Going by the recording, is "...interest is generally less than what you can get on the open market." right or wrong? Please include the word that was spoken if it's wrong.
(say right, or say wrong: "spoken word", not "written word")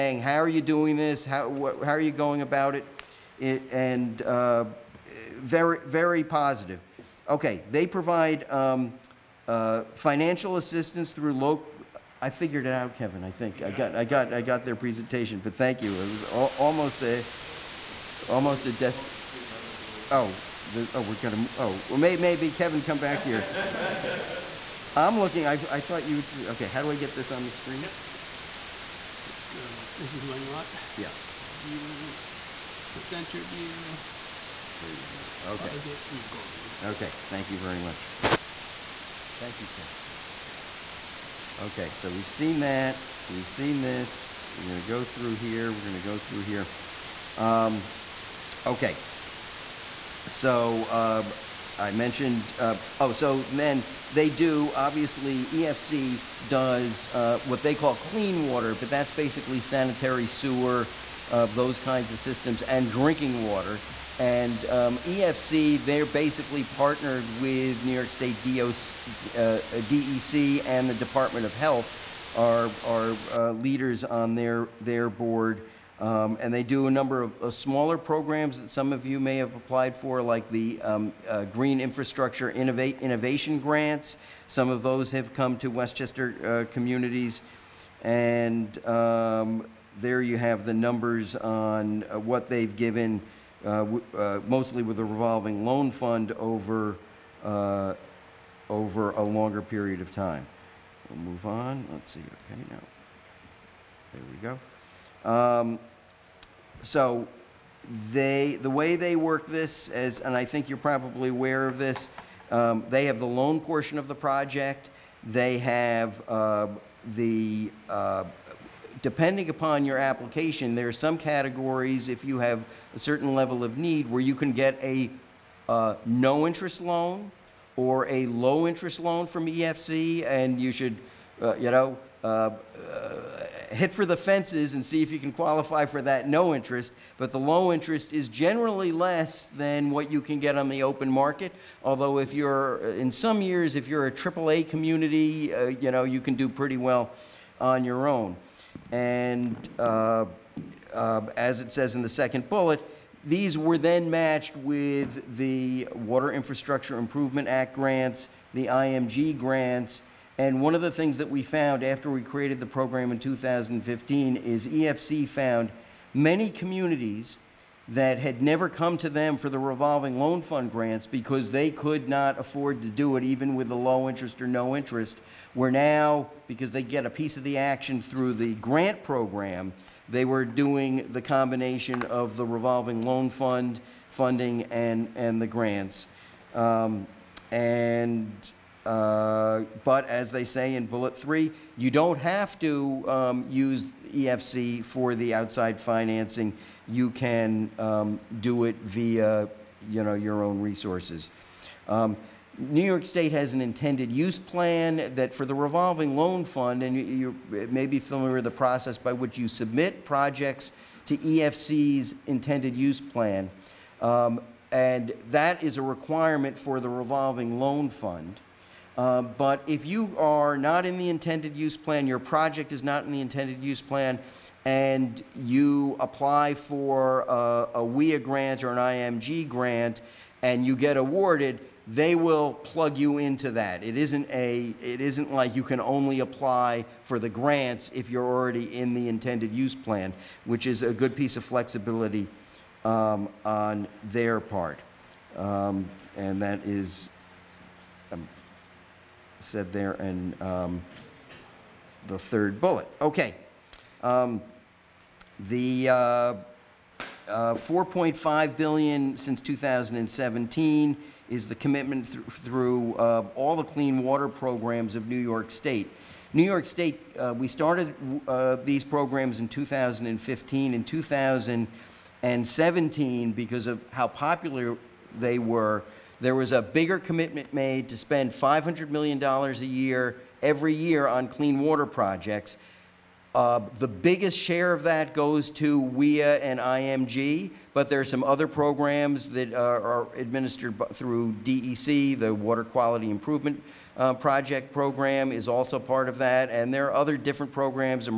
right.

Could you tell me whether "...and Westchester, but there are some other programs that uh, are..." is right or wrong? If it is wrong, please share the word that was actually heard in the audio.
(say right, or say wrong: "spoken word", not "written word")
wrong: "IMG", not "Westchester".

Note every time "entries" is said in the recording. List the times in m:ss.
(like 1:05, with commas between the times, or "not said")
not said.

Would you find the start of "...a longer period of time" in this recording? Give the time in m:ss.
1:39.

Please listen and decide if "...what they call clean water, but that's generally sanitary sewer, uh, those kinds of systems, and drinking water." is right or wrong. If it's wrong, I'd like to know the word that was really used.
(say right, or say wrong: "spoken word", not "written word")
wrong: "basically", not "generally".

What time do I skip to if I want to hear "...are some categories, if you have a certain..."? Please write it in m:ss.
2:00.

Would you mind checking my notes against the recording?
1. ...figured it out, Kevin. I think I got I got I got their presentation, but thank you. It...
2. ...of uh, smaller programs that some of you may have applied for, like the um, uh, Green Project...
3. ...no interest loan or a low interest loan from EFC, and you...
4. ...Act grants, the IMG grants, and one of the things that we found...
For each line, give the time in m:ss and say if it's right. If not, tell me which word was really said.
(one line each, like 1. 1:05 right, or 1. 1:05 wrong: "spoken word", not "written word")
1. 0:12 right
2. 1:17 wrong: "Infrastructure", not "Project"
3. 2:06 right
4. 2:37 right.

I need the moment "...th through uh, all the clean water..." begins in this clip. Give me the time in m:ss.
4:22.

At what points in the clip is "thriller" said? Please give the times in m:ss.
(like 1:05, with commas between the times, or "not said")
not said.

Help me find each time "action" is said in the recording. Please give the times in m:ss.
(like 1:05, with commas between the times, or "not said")
2:57.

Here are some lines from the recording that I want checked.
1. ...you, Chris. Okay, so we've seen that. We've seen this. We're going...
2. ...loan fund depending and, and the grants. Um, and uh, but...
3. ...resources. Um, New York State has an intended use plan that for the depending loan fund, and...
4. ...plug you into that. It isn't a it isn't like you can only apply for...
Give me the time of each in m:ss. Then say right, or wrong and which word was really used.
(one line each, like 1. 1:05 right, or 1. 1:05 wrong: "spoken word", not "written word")
1. 0:39 right
2. 3:03 wrong: "funding", not "depending"
3. 3:20 wrong: "revolving", not "depending"
4. 3:52 right.